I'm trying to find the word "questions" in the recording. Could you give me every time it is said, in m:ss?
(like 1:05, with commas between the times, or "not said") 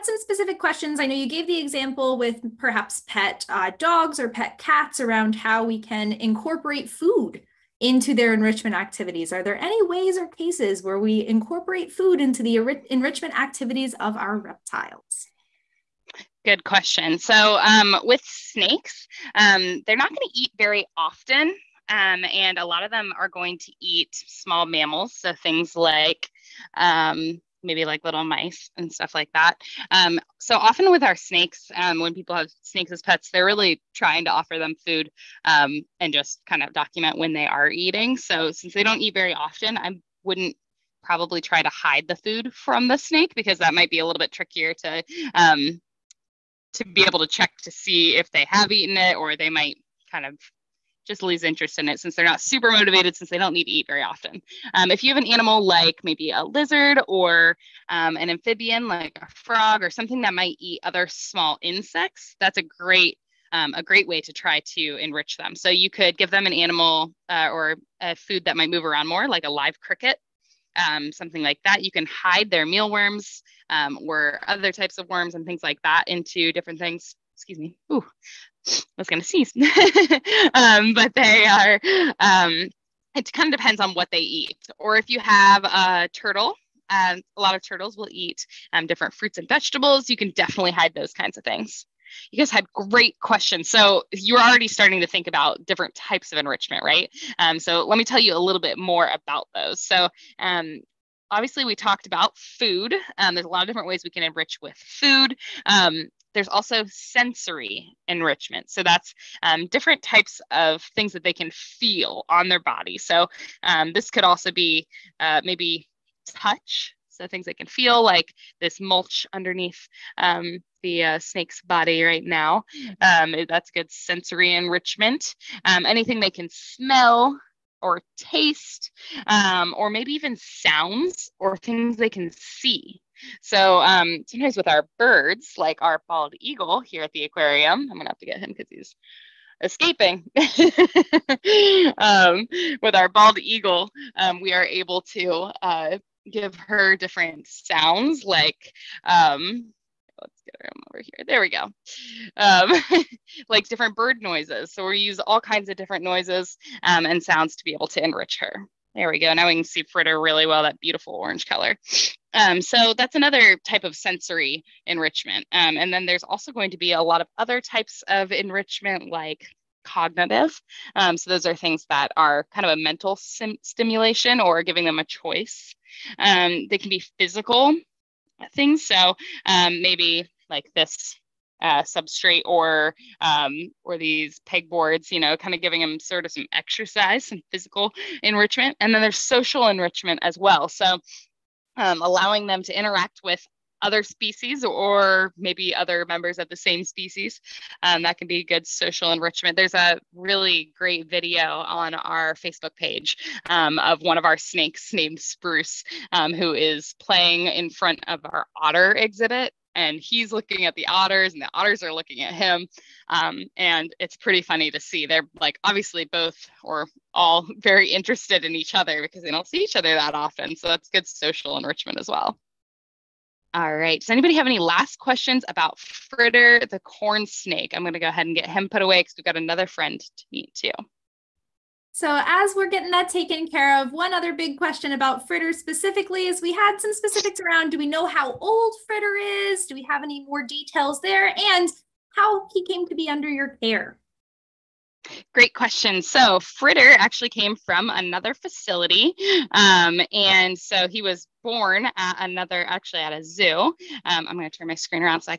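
0:00, 0:16, 1:33, 3:44, 3:54, 4:05.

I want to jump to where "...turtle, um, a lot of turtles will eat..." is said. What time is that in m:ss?
1:26.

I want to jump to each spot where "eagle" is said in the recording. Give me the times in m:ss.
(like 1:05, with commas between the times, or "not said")
2:16, 2:23.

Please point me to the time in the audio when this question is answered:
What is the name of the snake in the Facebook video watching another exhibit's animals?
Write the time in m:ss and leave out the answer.
3:25.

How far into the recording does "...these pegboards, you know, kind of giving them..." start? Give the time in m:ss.
3:03.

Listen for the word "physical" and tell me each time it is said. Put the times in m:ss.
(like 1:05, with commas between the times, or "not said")
2:57, 3:07.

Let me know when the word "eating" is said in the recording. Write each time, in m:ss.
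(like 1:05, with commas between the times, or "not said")
0:37.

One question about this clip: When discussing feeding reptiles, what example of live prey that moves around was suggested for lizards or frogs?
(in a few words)
live cricket.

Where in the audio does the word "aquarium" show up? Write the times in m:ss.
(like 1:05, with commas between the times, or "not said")
2:17.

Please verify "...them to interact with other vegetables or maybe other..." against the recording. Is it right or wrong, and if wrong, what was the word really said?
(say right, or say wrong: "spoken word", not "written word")
wrong: "species", not "vegetables".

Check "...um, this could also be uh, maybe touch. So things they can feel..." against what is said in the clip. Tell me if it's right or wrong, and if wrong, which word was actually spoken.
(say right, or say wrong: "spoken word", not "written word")
right.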